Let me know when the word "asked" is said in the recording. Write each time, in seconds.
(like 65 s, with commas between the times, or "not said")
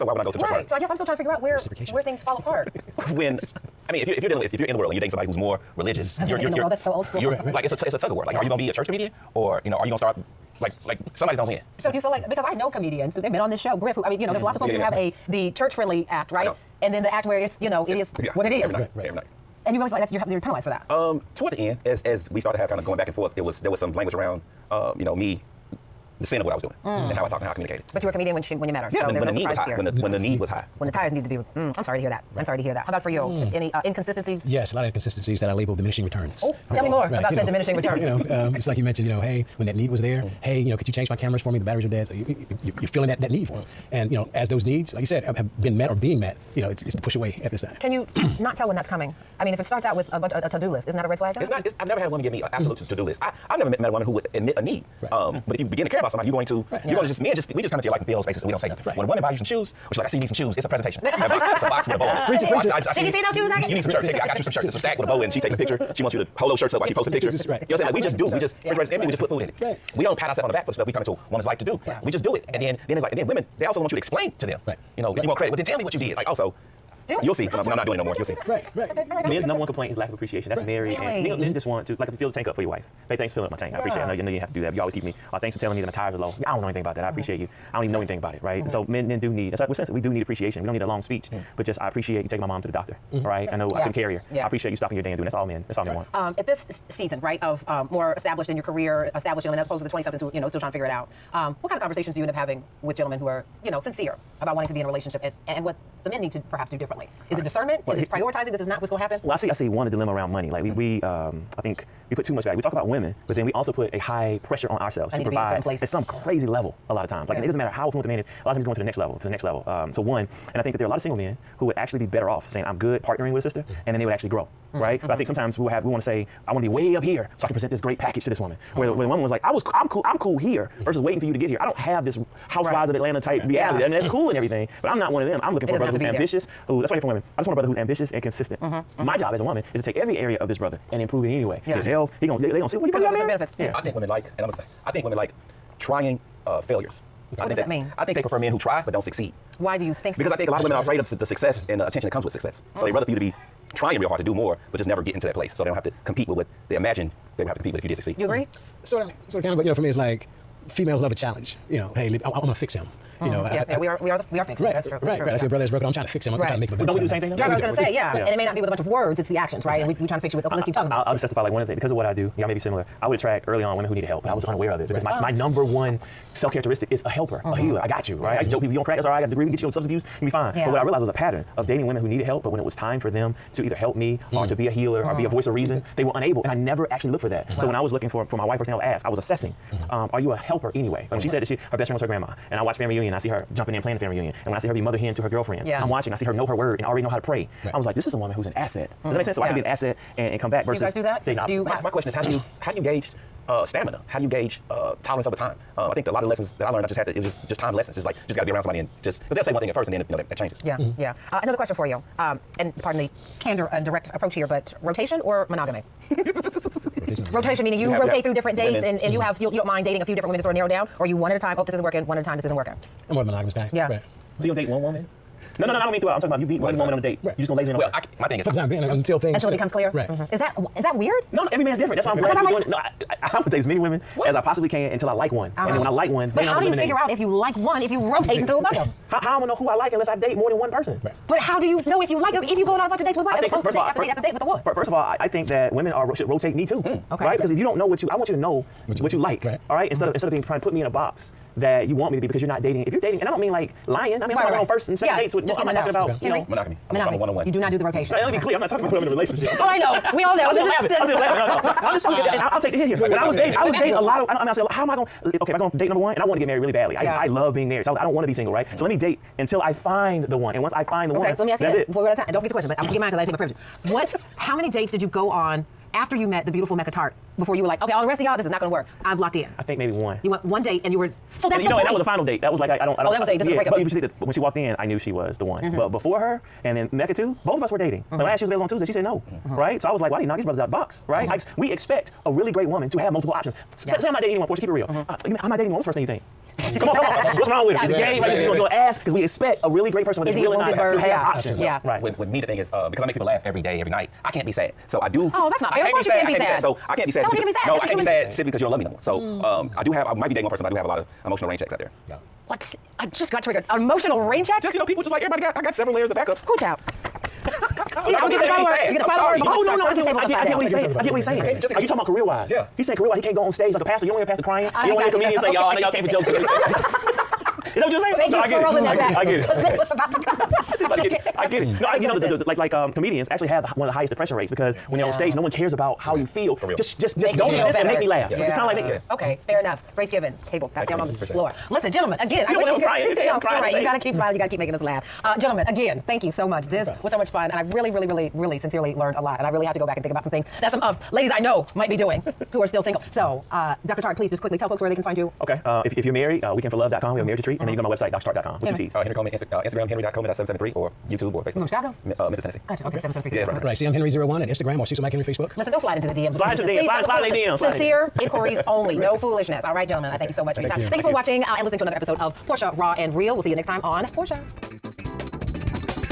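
288 s.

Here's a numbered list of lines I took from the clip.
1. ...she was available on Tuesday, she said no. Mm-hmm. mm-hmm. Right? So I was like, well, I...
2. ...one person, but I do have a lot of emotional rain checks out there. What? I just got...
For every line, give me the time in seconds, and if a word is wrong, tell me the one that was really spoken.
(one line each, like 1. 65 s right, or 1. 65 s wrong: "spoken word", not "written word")
1. 288 s right
2. 310 s right.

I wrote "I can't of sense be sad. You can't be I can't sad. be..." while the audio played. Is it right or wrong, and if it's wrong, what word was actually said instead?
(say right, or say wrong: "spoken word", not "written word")
wrong: "course", not "sense".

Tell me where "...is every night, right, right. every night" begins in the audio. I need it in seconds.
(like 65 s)
18 s.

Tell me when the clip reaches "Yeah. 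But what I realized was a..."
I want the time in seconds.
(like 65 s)
180 s.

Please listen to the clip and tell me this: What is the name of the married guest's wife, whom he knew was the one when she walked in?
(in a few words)
Mecca Tartt.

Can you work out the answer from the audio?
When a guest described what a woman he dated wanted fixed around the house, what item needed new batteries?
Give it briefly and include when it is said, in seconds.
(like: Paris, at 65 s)
Cameras, at 41 s.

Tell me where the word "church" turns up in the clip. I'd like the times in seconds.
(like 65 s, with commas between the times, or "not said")
0 s, 8 s, 15 s.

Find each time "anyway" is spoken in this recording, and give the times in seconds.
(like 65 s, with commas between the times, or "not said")
141 s, 190 s.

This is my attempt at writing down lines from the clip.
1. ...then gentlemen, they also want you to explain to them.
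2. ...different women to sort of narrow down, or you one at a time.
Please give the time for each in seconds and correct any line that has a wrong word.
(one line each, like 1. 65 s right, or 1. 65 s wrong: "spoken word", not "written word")
1. 73 s wrong: "women", not "gentlemen"
2. 220 s right.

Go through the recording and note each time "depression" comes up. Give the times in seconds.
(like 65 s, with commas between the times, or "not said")
334 s.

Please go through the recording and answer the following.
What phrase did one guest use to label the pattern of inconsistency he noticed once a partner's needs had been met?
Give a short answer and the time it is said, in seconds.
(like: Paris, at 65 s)
Diminishing returns, at 35 s.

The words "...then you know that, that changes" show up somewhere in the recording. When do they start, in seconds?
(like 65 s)
209 s.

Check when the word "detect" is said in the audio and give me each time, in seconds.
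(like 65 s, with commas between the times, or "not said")
not said.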